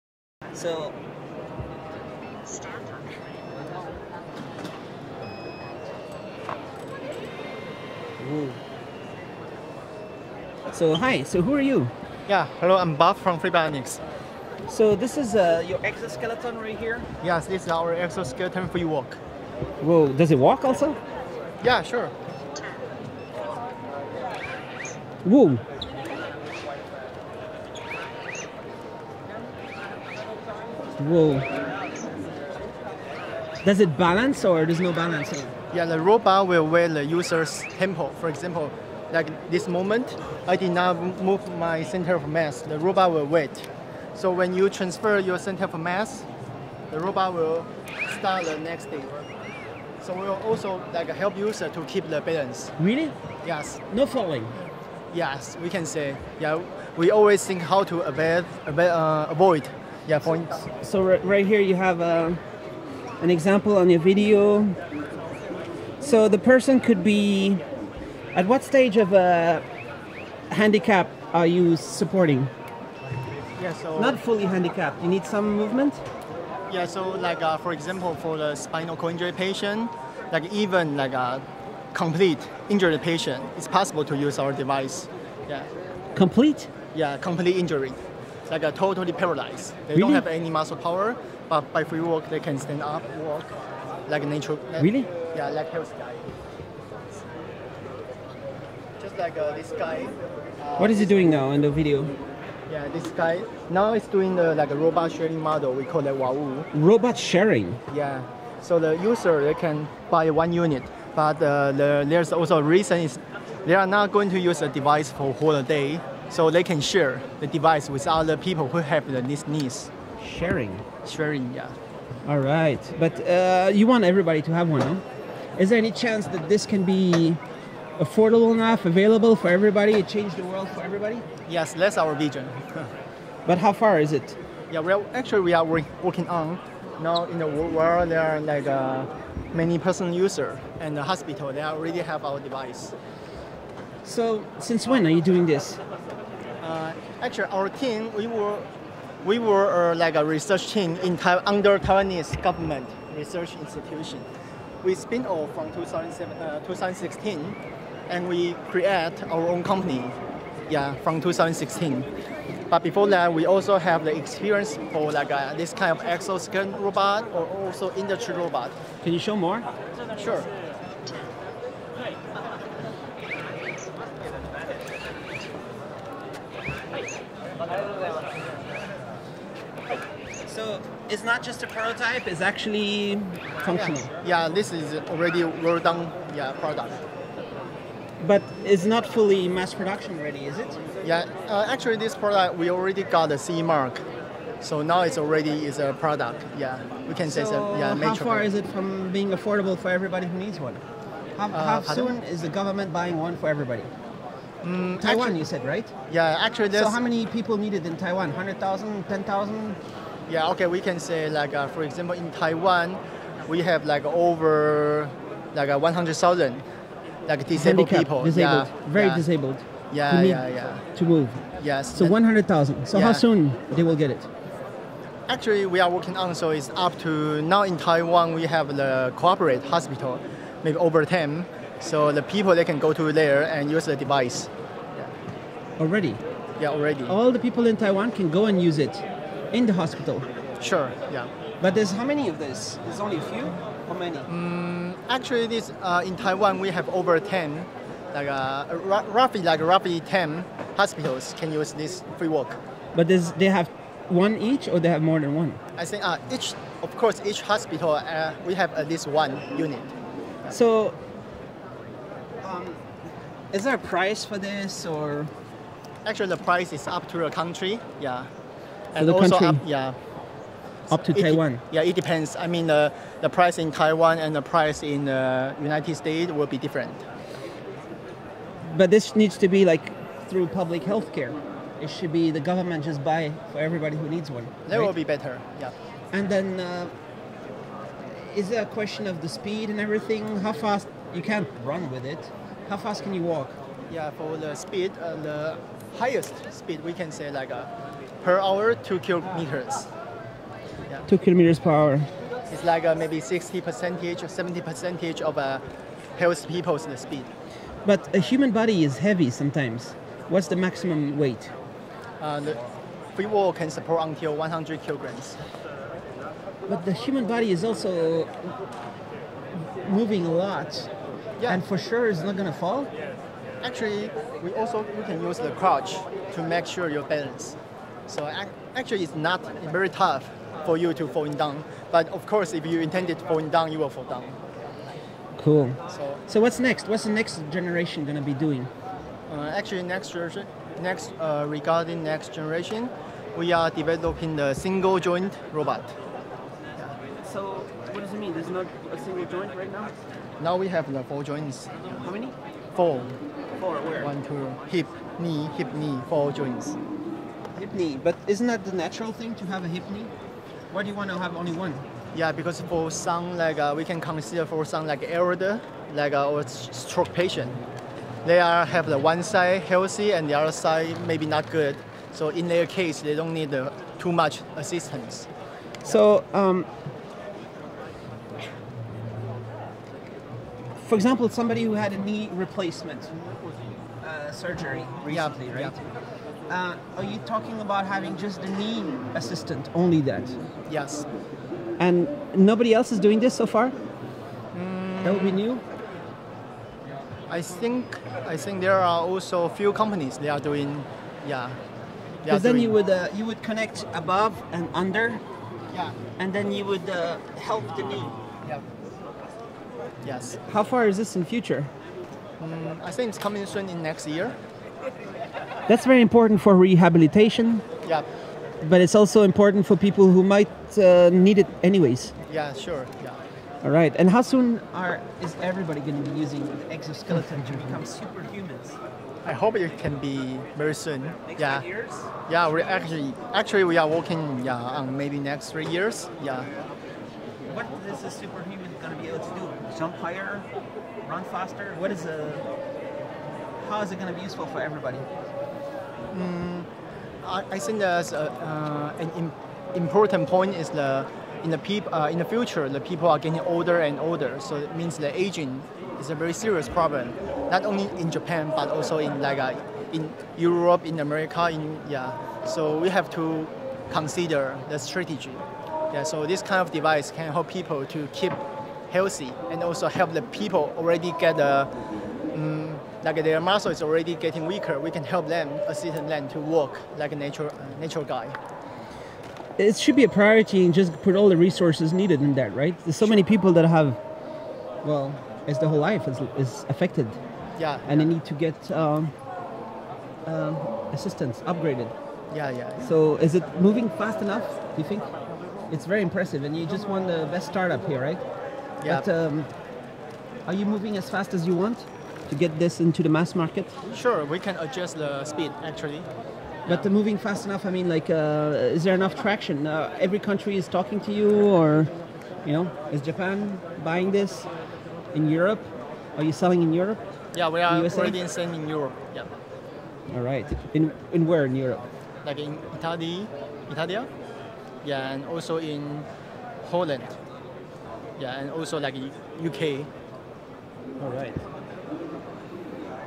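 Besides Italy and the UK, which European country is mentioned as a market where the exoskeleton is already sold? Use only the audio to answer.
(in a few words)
Holland.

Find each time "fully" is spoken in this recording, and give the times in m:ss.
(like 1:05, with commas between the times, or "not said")
1:14, 3:09.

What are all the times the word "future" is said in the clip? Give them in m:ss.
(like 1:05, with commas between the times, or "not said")
6:51, 7:32.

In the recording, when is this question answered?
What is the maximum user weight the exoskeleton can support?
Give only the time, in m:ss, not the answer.
5:14.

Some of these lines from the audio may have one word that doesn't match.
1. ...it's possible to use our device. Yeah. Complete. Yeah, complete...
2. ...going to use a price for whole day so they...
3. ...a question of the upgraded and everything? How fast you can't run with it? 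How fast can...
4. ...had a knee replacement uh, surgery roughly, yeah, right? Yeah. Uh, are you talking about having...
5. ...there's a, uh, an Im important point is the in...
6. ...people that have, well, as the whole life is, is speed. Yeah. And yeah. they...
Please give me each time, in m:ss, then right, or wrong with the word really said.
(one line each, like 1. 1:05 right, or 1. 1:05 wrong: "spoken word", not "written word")
1. 1:23 right
2. 1:54 wrong: "device", not "price"
3. 4:48 wrong: "speed", not "upgraded"
4. 6:21 wrong: "recently", not "roughly"
5. 7:27 right
6. 8:03 wrong: "affected", not "speed".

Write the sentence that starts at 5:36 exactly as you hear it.
What's the next generation going to be doing?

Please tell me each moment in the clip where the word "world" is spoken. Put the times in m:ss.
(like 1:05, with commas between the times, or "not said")
2:10, 2:17.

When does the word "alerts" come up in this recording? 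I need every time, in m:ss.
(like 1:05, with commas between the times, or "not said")
not said.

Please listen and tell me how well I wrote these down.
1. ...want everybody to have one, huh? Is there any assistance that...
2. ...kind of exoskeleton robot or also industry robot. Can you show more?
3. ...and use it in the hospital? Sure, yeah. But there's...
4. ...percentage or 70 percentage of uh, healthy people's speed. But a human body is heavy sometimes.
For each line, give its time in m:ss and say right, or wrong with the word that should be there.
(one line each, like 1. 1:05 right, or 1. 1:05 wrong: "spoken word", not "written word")
1. 2:03 wrong: "chance", not "assistance"
2. 2:45 right
3. 3:58 right
4. 5:03 right.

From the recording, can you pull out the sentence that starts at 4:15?
I think uh, each, of course, each hospital uh, we have at least one unit.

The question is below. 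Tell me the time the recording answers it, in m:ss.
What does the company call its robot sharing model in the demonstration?
1:45.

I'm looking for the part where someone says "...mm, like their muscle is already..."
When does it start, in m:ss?
7:52.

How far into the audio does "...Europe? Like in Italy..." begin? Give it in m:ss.
8:41.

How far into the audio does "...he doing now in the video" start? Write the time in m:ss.
1:40.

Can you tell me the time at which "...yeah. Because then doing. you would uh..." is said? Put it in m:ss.
6:41.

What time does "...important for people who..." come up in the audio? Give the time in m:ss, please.
6:59.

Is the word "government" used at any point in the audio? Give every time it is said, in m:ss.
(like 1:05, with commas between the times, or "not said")
2:32, 3:22, 4:42.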